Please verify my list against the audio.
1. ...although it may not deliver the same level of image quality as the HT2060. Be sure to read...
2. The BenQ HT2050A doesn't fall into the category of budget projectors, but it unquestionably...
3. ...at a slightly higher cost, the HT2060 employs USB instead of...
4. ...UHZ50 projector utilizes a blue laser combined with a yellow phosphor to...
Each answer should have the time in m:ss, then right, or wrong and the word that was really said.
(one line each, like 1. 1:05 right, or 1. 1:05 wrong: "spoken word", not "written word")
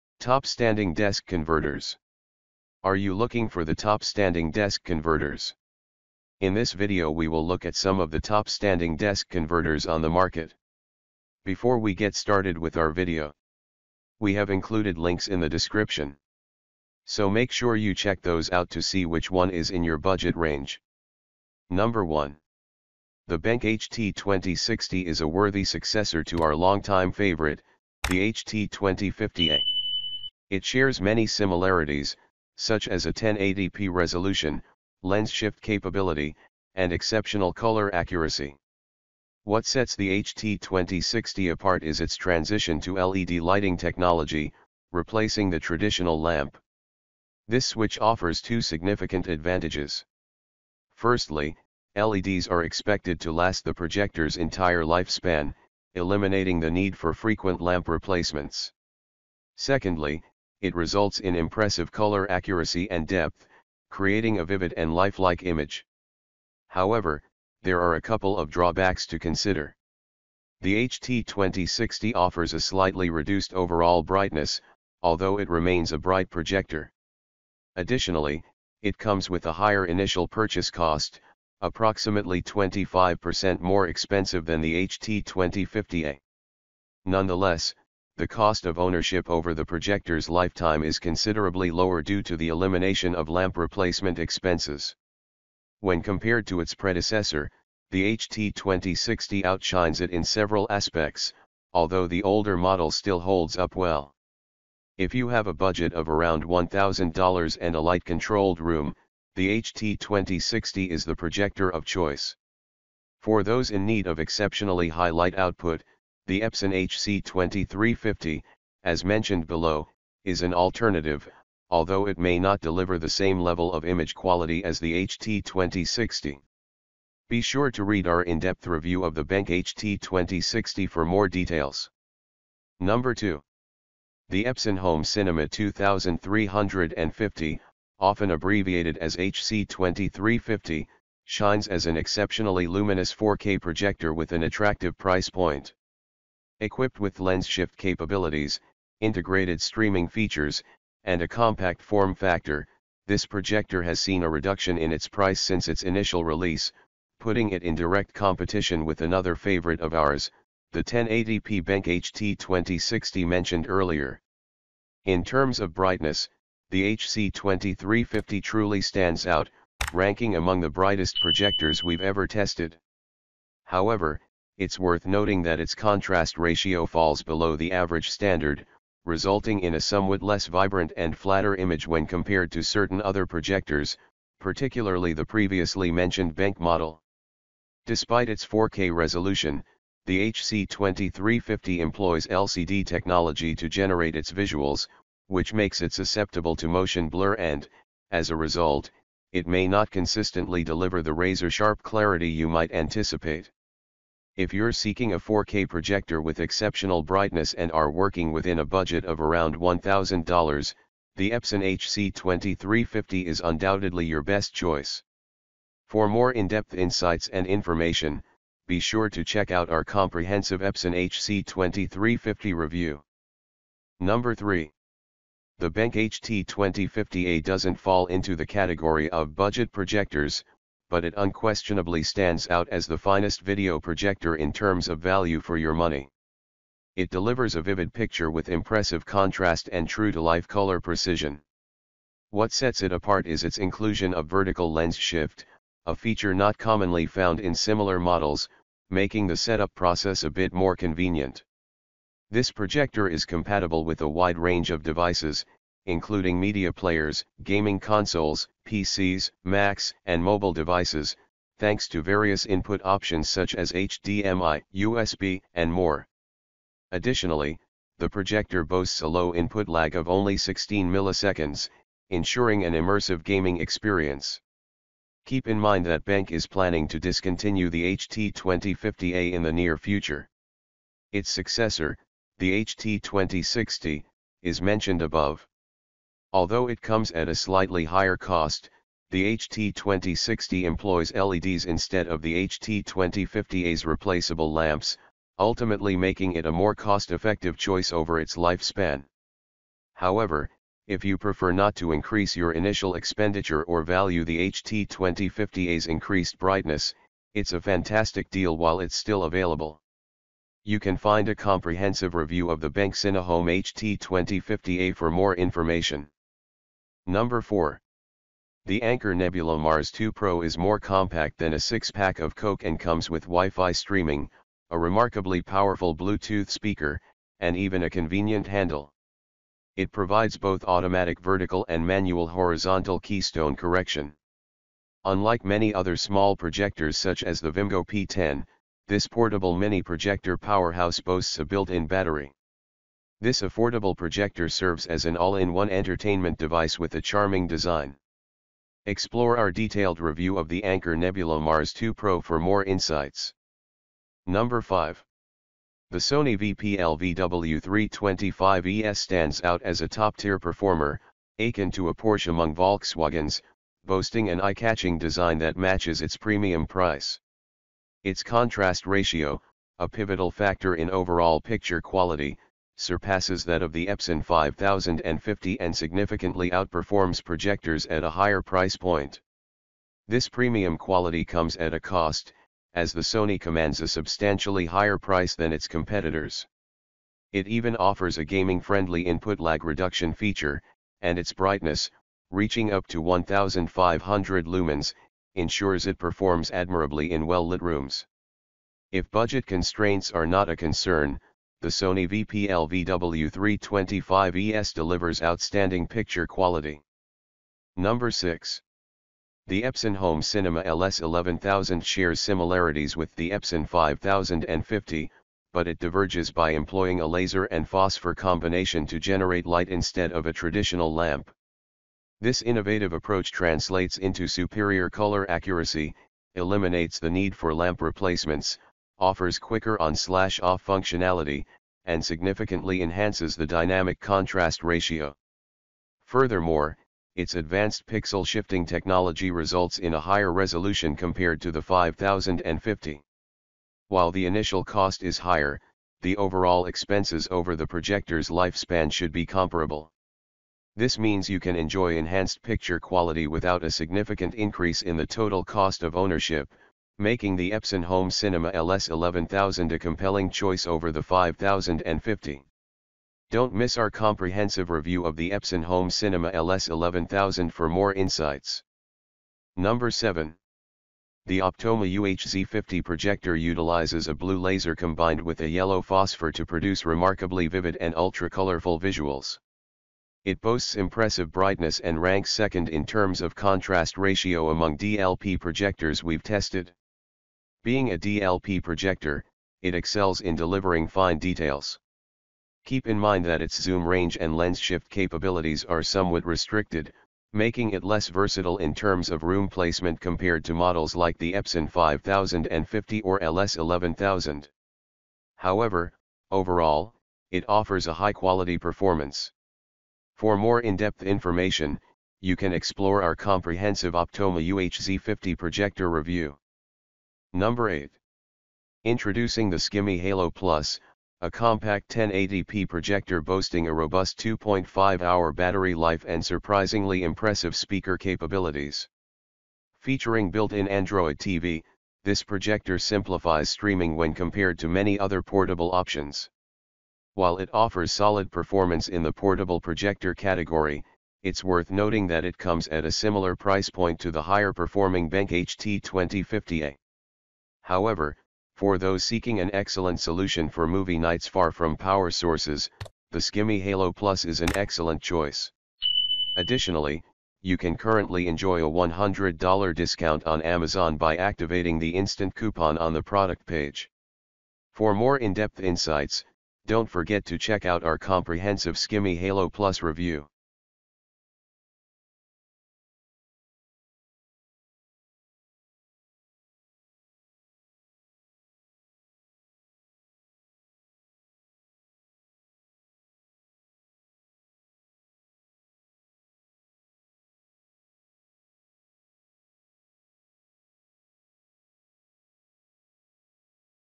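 1. 2:01 right
2. 3:45 right
3. 4:47 wrong: "LEDs", not "USB"
4. 7:51 right.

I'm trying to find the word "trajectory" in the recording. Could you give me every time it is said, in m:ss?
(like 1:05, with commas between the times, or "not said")
not said.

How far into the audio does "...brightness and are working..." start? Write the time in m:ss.
3:27.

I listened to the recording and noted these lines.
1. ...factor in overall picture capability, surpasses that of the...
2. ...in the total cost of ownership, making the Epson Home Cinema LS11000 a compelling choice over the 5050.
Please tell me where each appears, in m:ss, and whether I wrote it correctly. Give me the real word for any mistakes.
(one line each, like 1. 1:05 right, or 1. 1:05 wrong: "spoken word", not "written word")
1. 6:10 wrong: "quality", not "capability"
2. 7:34 right.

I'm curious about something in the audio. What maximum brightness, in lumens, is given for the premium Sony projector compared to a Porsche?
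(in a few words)
1500 lumens.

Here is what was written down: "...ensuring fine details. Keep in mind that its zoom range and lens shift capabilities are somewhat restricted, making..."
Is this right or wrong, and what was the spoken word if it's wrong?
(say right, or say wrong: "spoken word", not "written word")
wrong: "delivering", not "ensuring".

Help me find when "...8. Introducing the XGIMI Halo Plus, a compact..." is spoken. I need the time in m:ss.
8:37.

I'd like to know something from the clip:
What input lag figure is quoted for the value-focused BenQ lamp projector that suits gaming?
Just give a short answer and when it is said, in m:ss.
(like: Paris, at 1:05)
16 milliseconds, at 4:30.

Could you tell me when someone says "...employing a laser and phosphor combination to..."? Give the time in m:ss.
6:56.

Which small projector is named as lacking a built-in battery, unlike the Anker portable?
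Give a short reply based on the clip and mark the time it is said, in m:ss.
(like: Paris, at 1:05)
Vimgo P10, at 5:37.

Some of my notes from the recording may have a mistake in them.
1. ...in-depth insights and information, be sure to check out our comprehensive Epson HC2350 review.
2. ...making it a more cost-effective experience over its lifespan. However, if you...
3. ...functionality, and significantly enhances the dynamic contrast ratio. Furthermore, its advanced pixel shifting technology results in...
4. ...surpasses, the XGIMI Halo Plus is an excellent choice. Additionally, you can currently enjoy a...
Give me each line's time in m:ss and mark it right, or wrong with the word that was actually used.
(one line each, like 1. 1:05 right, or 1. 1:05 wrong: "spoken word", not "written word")
1. 3:36 right
2. 4:55 wrong: "choice", not "experience"
3. 7:10 right
4. 9:12 wrong: "sources", not "surpasses".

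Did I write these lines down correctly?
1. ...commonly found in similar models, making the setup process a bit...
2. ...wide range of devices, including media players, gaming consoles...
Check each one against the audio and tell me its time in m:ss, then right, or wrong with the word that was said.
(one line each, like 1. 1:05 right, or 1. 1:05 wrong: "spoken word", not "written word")
1. 4:06 right
2. 4:14 right.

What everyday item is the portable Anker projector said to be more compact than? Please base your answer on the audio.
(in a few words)
a 6-pack of Coke.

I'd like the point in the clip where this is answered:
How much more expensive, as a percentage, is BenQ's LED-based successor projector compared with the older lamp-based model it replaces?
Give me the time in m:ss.
1:22.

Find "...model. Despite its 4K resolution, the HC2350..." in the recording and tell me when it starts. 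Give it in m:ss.
3:06.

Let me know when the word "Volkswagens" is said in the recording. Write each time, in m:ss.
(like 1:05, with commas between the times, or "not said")
6:02.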